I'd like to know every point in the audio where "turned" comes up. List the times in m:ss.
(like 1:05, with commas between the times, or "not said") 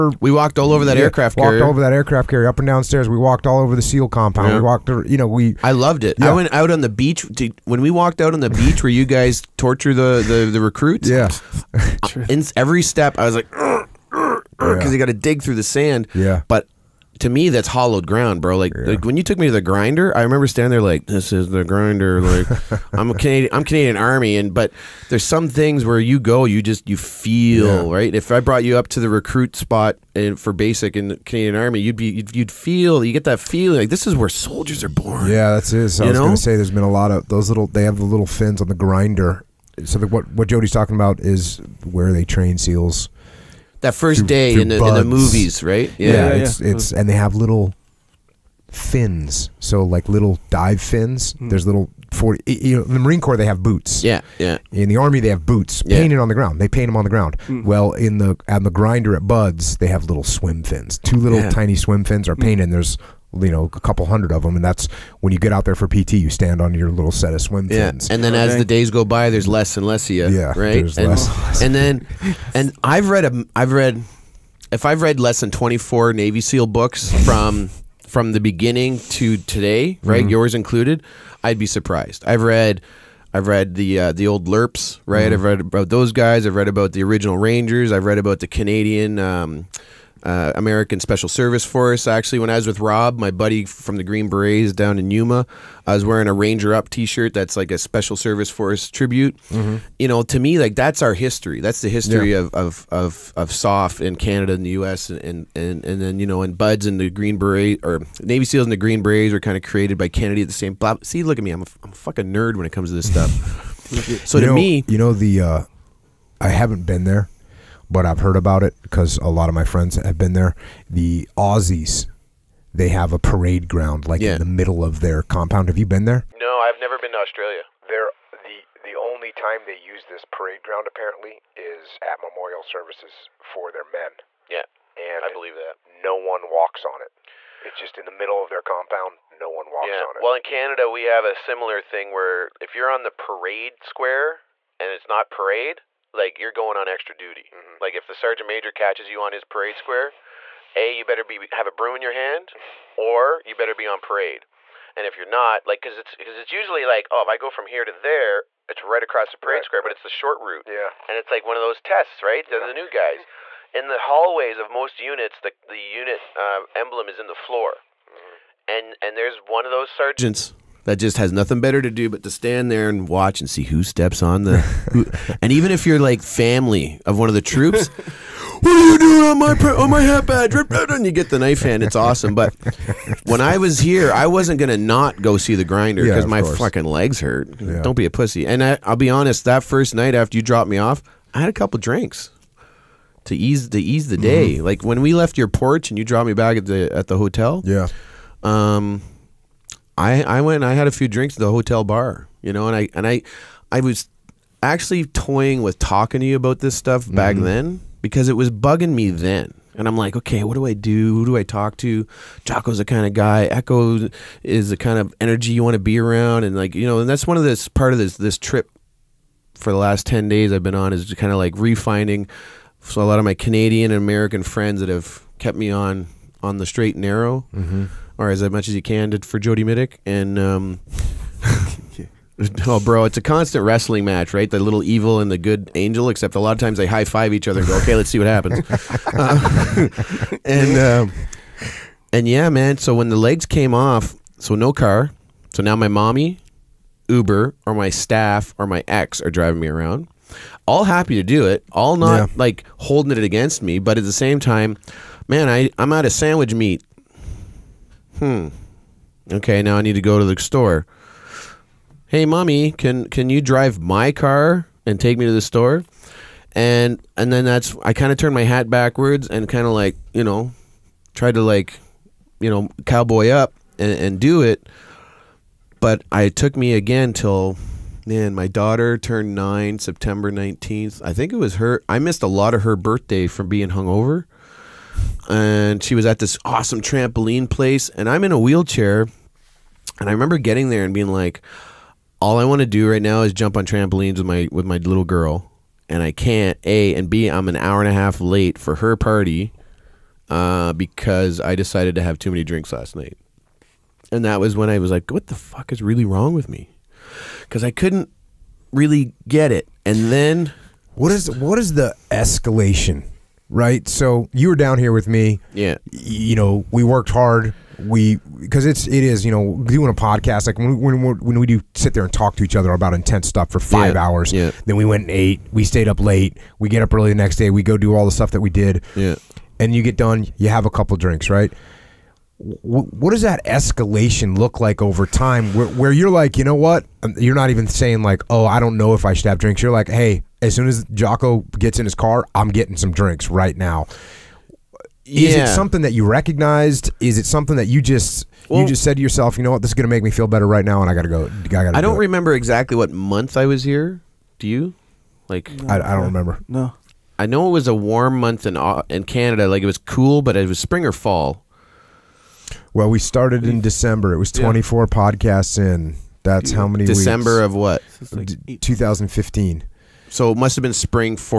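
4:28, 4:38.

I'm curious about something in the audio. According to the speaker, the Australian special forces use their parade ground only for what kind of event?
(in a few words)
memorial services.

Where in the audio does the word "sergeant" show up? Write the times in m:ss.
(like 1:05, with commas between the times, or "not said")
2:28, 2:49.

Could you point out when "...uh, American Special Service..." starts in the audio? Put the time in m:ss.
1:30.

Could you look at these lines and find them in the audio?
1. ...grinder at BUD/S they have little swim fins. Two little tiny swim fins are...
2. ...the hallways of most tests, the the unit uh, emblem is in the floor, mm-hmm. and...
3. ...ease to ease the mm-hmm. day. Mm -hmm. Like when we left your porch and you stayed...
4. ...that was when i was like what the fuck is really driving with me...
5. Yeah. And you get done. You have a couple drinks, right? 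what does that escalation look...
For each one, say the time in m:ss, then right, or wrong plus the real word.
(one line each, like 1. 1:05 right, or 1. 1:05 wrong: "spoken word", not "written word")
1. 0:58 right
2. 2:43 wrong: "units", not "tests"
3. 3:13 wrong: "dropped", not "stayed"
4. 5:04 wrong: "wrong", not "driving"
5. 5:28 right.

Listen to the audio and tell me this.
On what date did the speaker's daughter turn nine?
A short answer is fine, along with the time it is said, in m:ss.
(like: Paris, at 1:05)
September 19, at 4:39.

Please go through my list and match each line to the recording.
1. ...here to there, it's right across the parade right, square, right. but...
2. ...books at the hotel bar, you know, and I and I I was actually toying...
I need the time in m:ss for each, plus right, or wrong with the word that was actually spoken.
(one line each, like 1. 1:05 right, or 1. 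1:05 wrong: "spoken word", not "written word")
1. 2:37 right
2. 3:21 wrong: "drinks", not "books".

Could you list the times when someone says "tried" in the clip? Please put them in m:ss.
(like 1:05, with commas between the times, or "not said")
4:31.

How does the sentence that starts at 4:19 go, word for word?
Okay, now I need to go to the store.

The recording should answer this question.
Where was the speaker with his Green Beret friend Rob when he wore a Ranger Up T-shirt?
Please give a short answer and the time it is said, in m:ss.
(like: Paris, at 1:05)
Yuma, at 1:35.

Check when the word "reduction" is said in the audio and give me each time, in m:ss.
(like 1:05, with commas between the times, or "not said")
not said.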